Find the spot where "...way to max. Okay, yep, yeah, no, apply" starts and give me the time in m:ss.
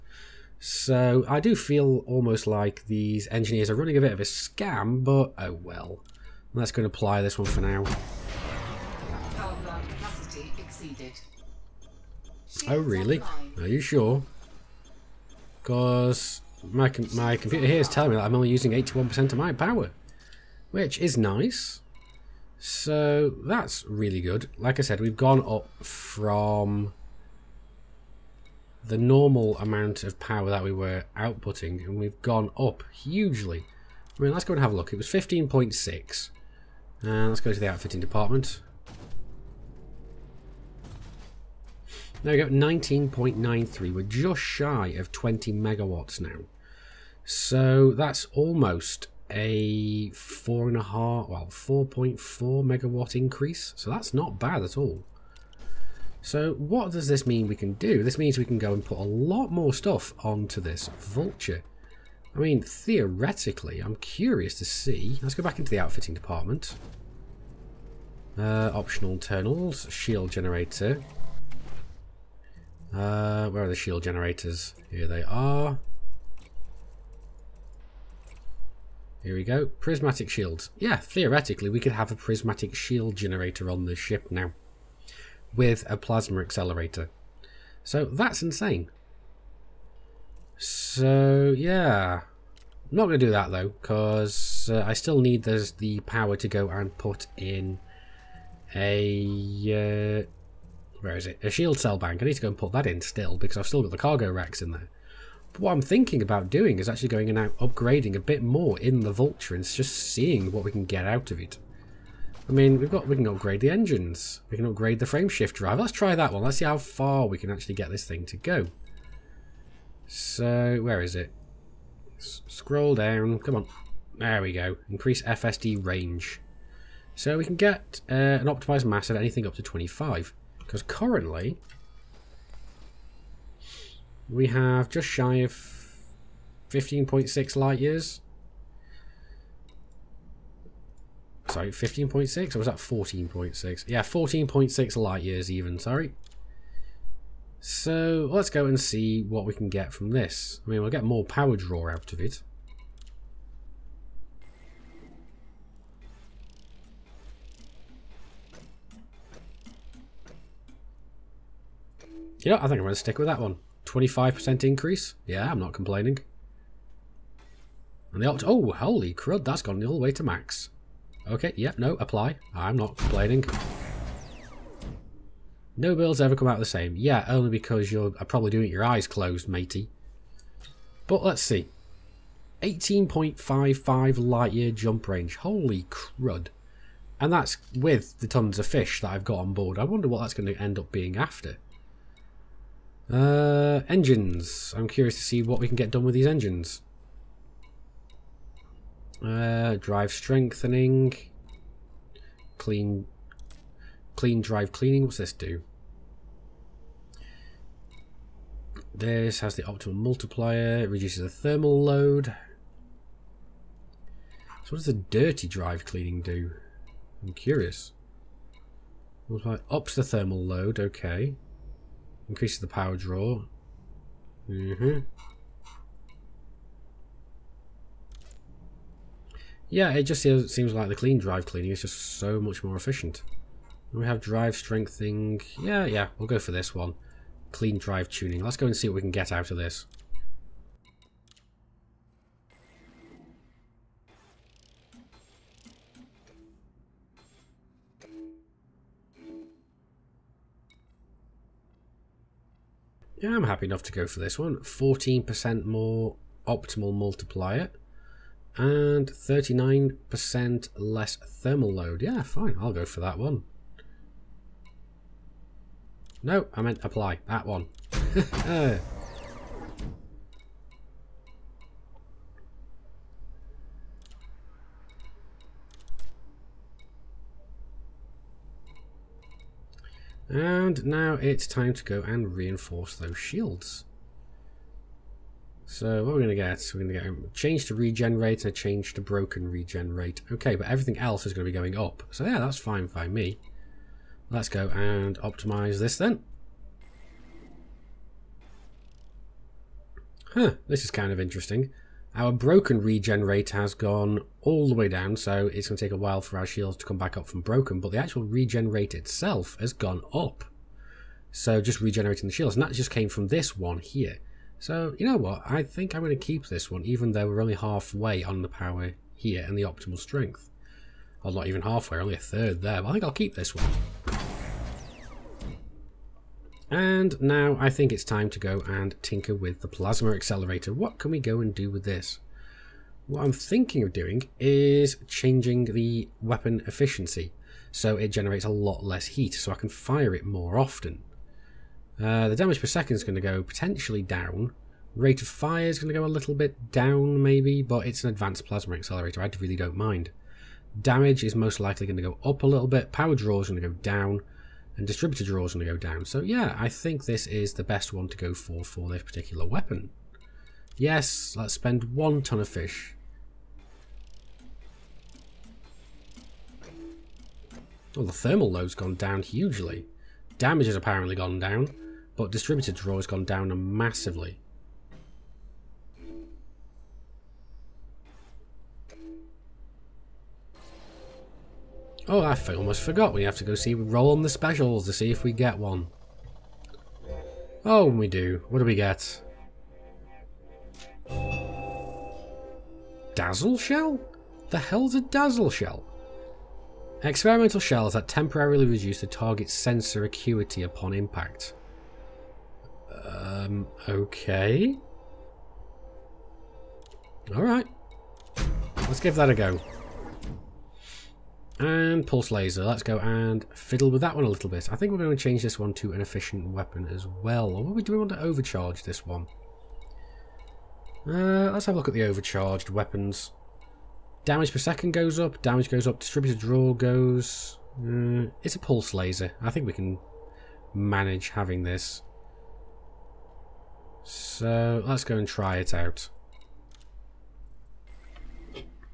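2:49.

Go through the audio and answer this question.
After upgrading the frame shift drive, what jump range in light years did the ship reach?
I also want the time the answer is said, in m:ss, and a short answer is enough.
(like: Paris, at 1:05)
18.55, at 3:02.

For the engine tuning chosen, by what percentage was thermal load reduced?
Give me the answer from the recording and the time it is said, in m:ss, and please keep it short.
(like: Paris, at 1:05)
39%, at 4:19.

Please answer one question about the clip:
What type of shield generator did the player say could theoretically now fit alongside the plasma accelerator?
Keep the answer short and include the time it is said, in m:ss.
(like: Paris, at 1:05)
Prismatic shields, at 1:19.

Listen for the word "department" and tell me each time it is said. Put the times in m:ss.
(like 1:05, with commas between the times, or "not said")
0:37, 1:06.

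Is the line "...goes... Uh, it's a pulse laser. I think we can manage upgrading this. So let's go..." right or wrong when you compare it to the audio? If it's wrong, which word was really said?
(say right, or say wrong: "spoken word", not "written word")
wrong: "having", not "upgrading".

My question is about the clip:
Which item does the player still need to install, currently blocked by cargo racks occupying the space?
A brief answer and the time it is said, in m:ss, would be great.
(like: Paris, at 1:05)
A shield cell bank, at 1:41.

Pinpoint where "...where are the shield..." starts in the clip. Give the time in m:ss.
1:13.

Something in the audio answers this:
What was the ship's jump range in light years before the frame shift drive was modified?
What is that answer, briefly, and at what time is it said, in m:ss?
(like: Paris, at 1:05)
14.6 light years, at 2:24.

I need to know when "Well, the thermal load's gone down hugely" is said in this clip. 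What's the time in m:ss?
6:07.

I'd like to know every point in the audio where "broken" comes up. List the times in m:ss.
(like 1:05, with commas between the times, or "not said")
4:49, 5:02, 5:07.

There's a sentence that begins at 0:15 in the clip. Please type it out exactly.
Because my my computer here is telling me that I'm only using 81% of my power, which is nice.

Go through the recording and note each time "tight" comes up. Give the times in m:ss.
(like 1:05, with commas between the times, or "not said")
not said.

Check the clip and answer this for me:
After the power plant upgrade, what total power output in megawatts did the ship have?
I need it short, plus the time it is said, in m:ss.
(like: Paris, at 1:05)
19.93, at 0:42.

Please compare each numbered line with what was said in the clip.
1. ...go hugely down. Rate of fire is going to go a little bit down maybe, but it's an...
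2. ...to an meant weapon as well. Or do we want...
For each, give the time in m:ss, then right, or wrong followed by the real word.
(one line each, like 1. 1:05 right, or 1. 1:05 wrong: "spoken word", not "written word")
1. 5:43 wrong: "potentially", not "hugely"
2. 6:55 wrong: "efficient", not "meant".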